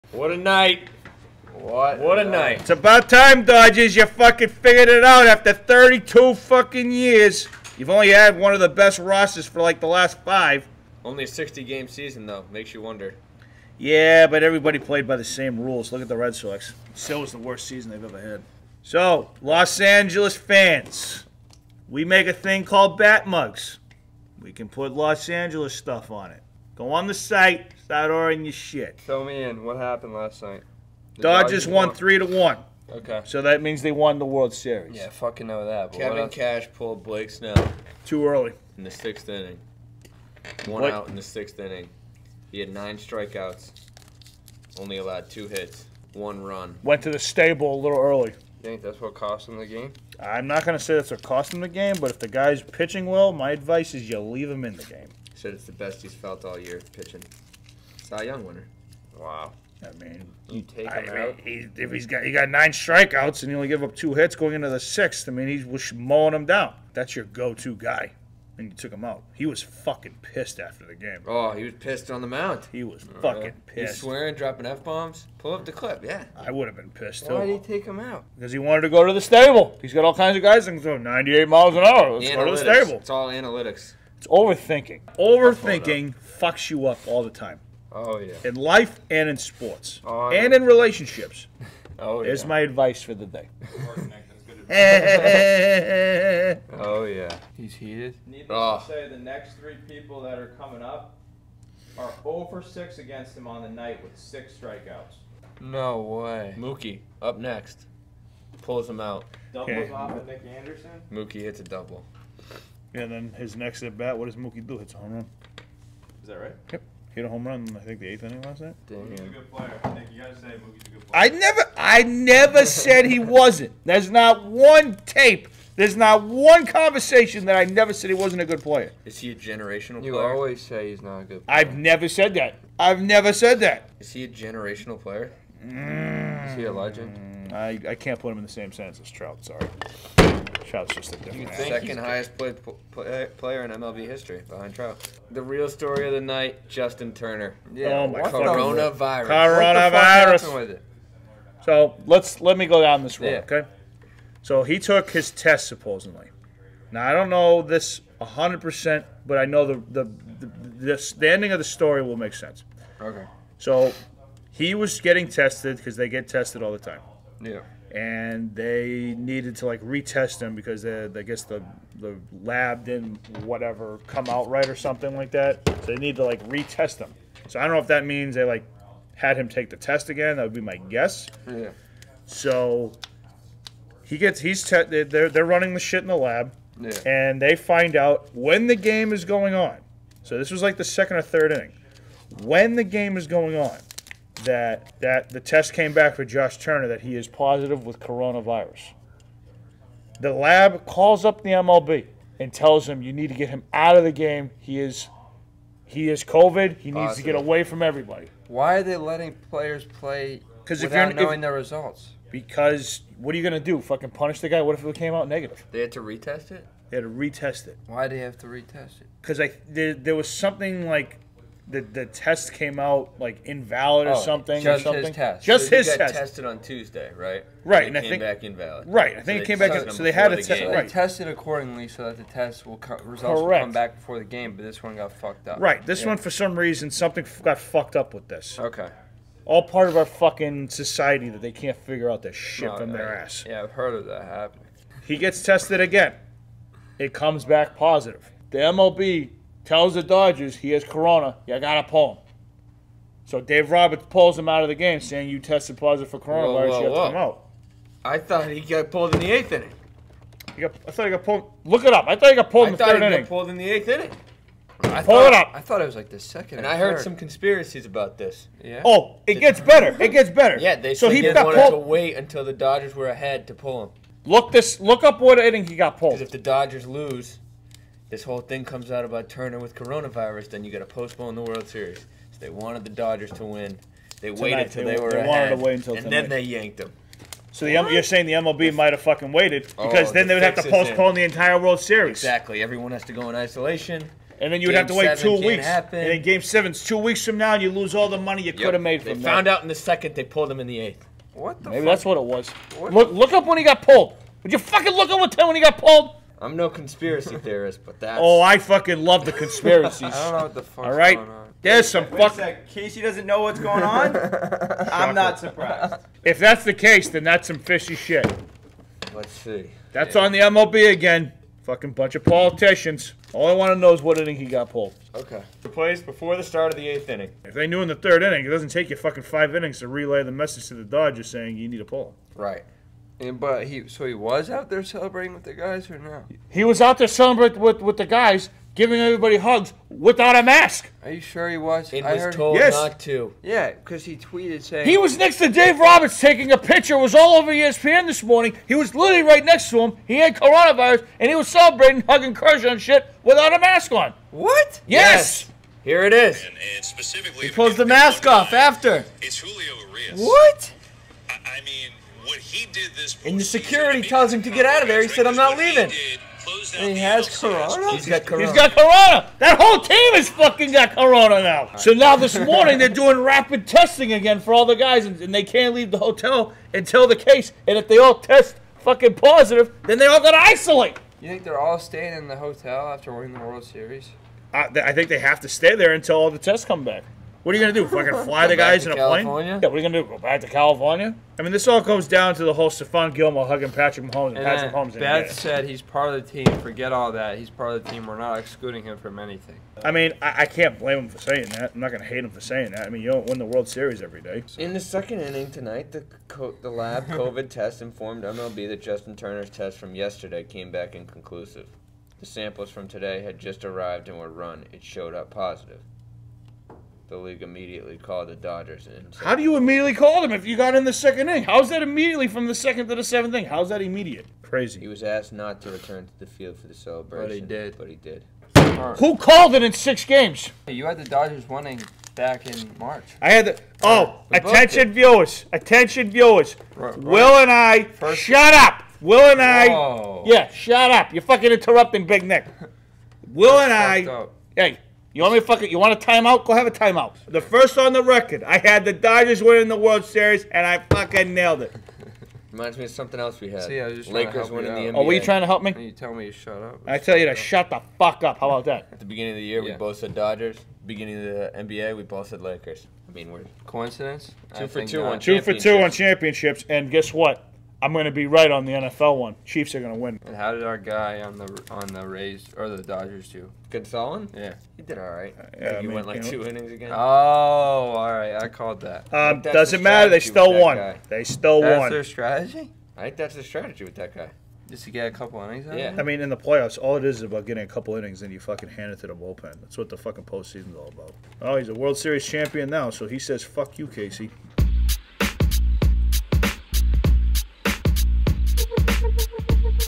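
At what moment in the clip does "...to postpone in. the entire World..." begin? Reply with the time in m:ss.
4:50.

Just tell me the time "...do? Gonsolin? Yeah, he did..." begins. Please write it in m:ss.
7:53.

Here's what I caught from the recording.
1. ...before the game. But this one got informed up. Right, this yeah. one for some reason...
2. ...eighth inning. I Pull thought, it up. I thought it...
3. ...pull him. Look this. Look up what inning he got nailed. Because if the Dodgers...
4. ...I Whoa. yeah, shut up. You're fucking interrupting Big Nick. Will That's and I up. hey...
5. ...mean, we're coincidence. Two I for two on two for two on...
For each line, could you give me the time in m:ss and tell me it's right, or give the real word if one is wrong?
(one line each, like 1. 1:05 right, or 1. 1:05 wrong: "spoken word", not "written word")
1. 3:53 wrong: "fucked", not "informed"
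2. 4:23 right
3. 4:33 wrong: "pulled", not "nailed"
4. 7:19 right
5. 7:43 right.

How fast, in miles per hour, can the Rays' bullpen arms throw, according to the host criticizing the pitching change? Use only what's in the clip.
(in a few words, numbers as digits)
98.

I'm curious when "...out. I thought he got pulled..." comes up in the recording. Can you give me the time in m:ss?
4:17.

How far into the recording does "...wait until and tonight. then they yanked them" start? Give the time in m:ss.
4:45.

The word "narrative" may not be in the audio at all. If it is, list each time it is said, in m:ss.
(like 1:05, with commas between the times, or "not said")
not said.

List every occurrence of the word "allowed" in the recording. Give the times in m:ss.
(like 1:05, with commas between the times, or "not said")
0:44.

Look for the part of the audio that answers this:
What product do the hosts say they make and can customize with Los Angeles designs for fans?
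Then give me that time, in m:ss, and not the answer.
0:22.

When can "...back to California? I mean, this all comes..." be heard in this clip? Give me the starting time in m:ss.
6:30.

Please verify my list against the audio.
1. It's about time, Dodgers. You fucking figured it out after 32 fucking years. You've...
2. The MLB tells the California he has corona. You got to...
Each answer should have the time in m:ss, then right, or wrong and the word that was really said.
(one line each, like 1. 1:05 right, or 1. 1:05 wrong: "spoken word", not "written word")
1. 0:02 right
2. 4:08 wrong: "Dodgers", not "California".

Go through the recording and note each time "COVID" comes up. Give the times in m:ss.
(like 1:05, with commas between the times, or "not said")
3:26, 6:47.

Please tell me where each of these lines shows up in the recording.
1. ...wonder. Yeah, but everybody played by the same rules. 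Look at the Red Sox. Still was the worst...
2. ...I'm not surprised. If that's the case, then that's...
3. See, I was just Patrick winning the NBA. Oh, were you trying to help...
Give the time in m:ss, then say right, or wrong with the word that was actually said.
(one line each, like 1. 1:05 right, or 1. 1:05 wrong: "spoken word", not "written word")
1. 0:12 right
2. 5:14 right
3. 7:33 wrong: "Lakers", not "Patrick".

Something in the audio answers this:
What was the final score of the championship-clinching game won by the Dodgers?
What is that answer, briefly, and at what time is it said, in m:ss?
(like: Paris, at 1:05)
3 to 1, at 0:31.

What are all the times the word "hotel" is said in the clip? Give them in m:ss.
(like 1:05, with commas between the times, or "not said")
6:15, 6:22.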